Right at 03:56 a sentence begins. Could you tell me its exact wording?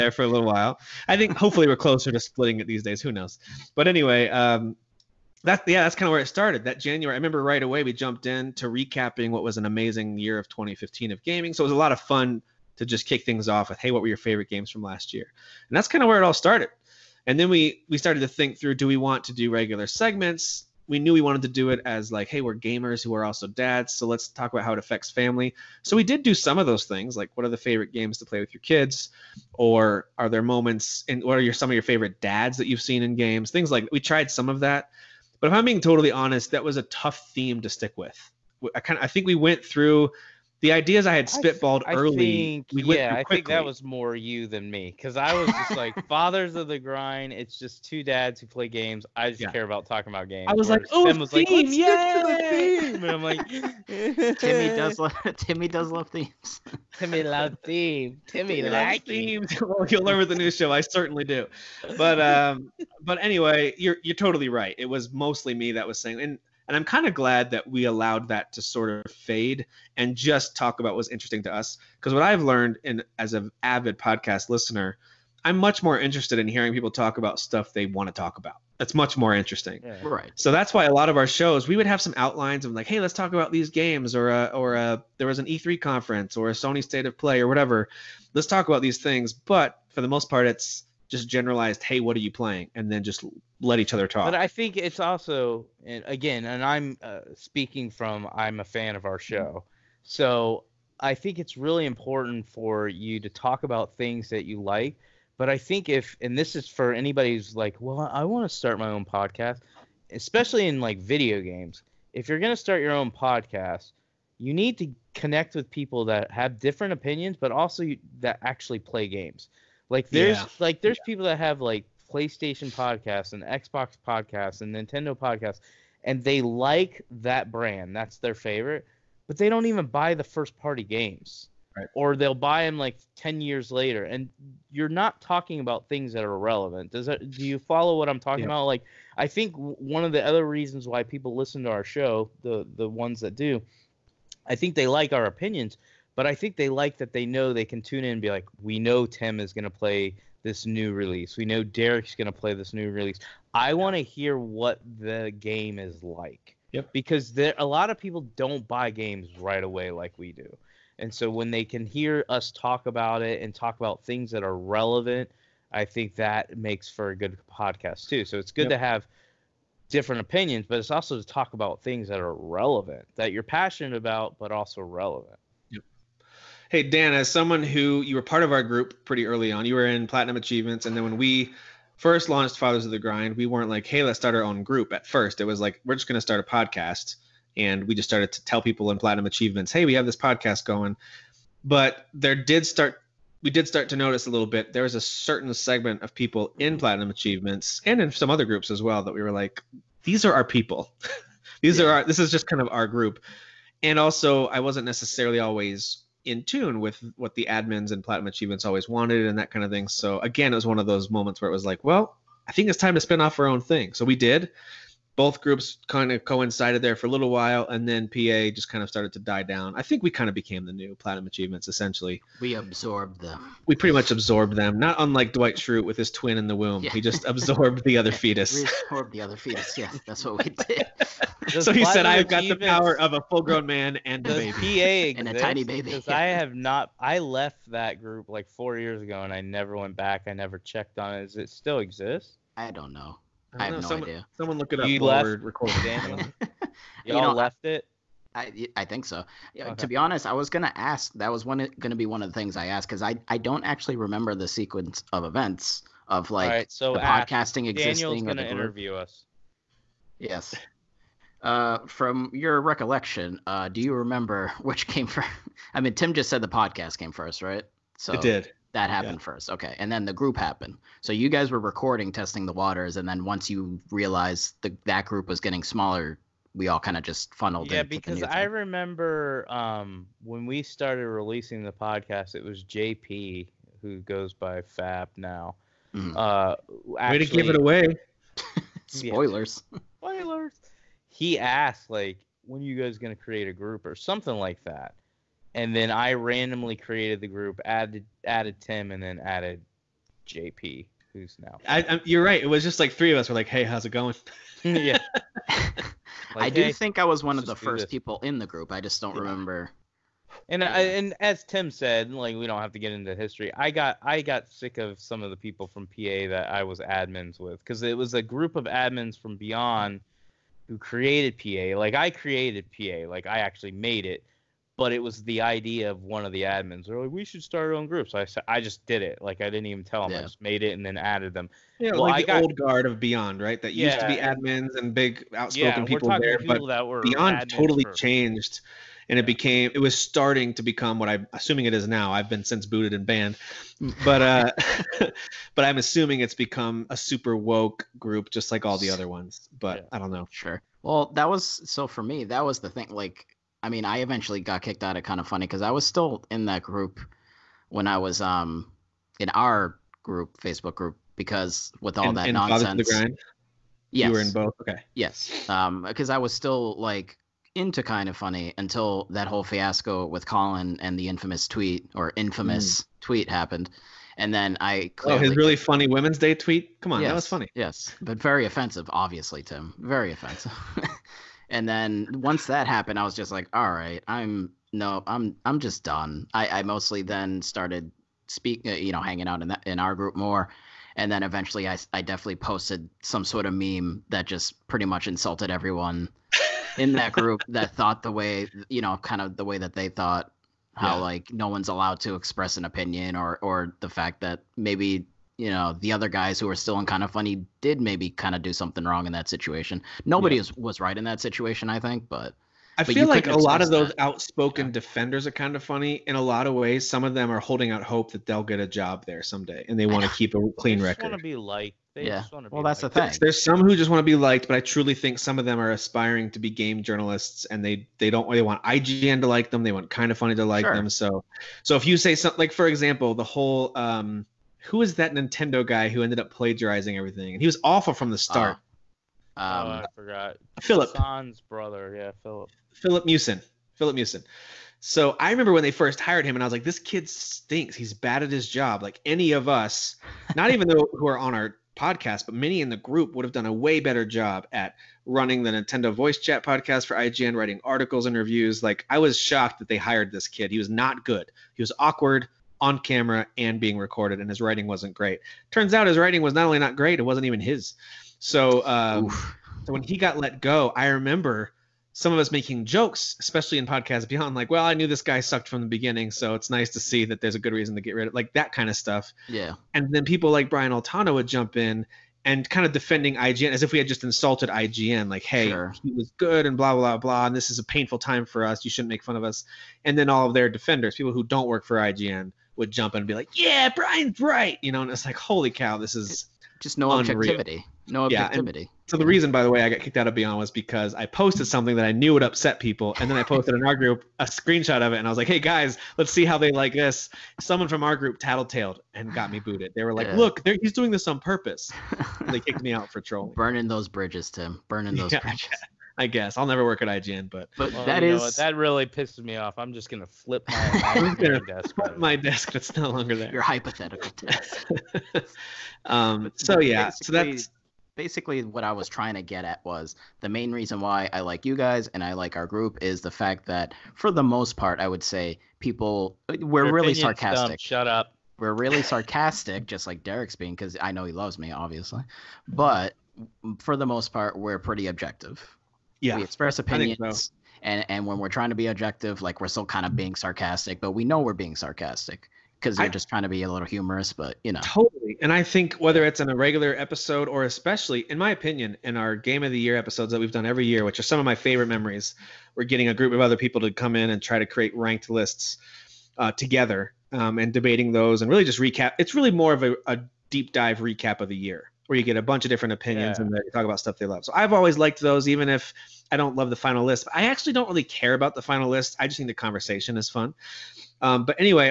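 I left that group like four years ago, and I never went back.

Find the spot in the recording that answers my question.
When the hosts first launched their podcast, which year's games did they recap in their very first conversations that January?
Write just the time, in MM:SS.
00:10.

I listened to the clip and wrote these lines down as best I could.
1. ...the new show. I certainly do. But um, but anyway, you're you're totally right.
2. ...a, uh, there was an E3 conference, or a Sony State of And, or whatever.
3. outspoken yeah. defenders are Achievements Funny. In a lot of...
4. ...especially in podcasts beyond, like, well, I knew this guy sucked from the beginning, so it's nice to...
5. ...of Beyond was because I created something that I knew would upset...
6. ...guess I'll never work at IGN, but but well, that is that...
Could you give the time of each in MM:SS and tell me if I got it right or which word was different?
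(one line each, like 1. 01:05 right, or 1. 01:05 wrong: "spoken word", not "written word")
1. 01:00 right
2. 01:24 wrong: "Play", not "And"
3. 06:54 wrong: "Kinda", not "Achievements"
4. 07:53 right
5. 08:20 wrong: "posted", not "created"
6. 08:36 right.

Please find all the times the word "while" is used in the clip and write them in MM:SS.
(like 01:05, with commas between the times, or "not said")
00:00, 03:37.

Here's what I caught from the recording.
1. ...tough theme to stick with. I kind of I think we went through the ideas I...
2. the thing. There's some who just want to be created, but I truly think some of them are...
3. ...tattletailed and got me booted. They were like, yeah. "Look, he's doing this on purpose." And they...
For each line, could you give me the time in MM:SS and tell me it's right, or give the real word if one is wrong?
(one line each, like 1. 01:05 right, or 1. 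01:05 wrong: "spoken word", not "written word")
1. 00:36 right
2. 07:02 wrong: "liked", not "created"
3. 08:28 right.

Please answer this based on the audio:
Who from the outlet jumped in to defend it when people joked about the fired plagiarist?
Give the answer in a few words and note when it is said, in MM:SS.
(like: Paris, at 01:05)
Brian Altano, at 08:00.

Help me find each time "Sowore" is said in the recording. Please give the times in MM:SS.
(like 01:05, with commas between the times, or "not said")
not said.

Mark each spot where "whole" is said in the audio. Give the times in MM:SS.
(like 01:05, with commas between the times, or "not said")
06:09, 07:13.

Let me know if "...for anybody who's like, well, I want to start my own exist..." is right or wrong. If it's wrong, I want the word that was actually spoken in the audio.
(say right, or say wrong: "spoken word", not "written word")
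wrong: "podcast", not "exist".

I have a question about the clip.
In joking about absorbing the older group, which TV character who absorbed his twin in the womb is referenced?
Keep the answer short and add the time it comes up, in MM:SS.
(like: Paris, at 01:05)
Dwight Schrute, at 03:45.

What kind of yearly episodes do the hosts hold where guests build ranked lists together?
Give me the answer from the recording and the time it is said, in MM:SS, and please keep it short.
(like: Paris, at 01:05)
game of the year, at 09:19.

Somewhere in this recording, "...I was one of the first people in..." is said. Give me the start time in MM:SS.
05:06.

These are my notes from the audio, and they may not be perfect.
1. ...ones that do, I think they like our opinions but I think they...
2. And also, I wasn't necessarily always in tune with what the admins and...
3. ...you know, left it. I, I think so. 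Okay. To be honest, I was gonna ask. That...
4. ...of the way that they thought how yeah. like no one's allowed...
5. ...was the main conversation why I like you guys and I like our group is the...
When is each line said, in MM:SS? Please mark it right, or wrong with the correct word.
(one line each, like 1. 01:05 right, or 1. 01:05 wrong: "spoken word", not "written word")
1. 02:22 right
2. 03:23 right
3. 04:07 right
4. 06:39 right
5. 08:49 wrong: "reason", not "conversation".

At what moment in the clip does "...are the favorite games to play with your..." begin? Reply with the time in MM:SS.
00:27.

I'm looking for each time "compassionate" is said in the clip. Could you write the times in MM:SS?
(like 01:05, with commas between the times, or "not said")
not said.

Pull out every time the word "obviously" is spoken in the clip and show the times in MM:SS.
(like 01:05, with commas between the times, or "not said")
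06:18, 09:01.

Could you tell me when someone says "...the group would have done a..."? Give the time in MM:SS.
07:32.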